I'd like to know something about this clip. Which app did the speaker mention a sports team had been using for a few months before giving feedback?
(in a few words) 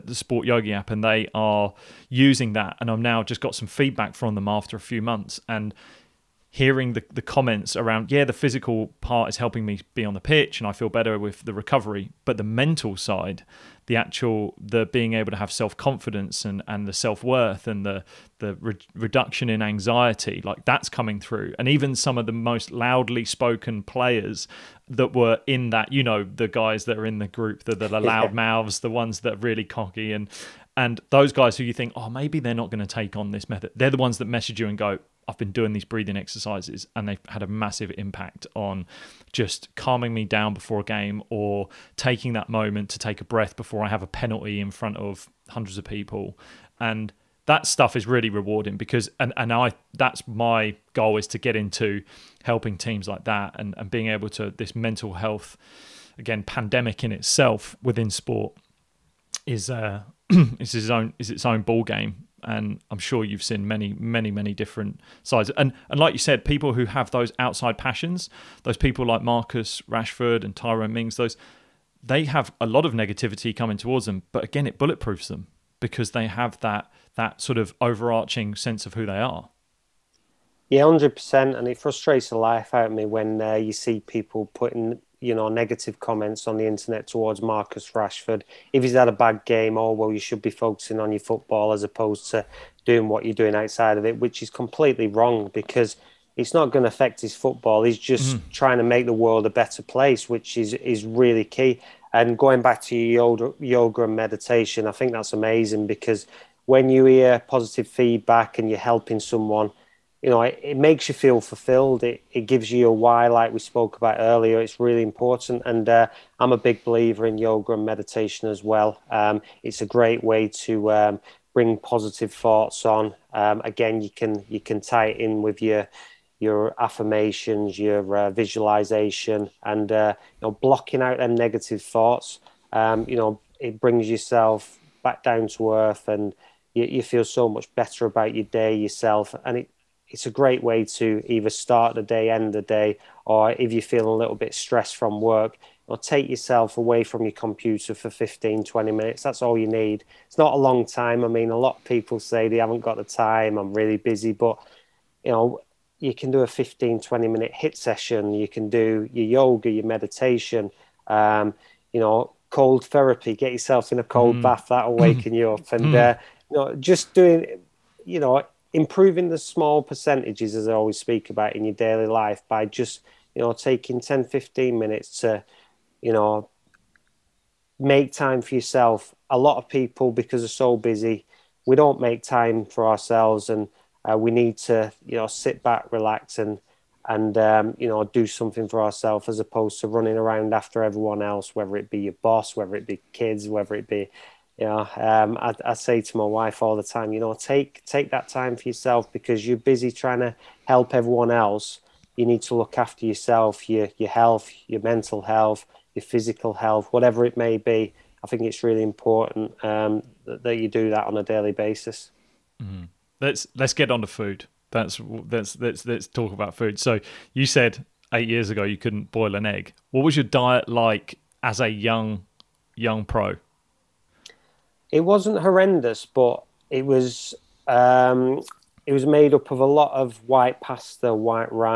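Sport Yogi.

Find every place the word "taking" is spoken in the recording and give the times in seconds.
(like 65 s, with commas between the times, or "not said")
41 s, 173 s.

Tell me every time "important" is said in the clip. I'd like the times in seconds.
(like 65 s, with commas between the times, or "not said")
115 s, 208 s.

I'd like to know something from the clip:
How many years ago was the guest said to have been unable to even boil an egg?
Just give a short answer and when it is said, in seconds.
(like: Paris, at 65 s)
8, at 218 s.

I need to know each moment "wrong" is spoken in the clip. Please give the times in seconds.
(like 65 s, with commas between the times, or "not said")
95 s.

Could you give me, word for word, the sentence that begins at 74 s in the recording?
But again, it bulletproofs them because they have that that sort of overarching sense of who they are.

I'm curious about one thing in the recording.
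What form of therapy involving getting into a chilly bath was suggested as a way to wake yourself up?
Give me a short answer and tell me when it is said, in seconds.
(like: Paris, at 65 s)
Cold therapy, at 162 s.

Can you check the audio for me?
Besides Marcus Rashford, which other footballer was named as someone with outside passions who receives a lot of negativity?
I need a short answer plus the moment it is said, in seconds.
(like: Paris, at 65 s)
Tyrone Mings, at 70 s.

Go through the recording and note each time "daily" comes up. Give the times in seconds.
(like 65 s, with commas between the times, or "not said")
171 s, 211 s.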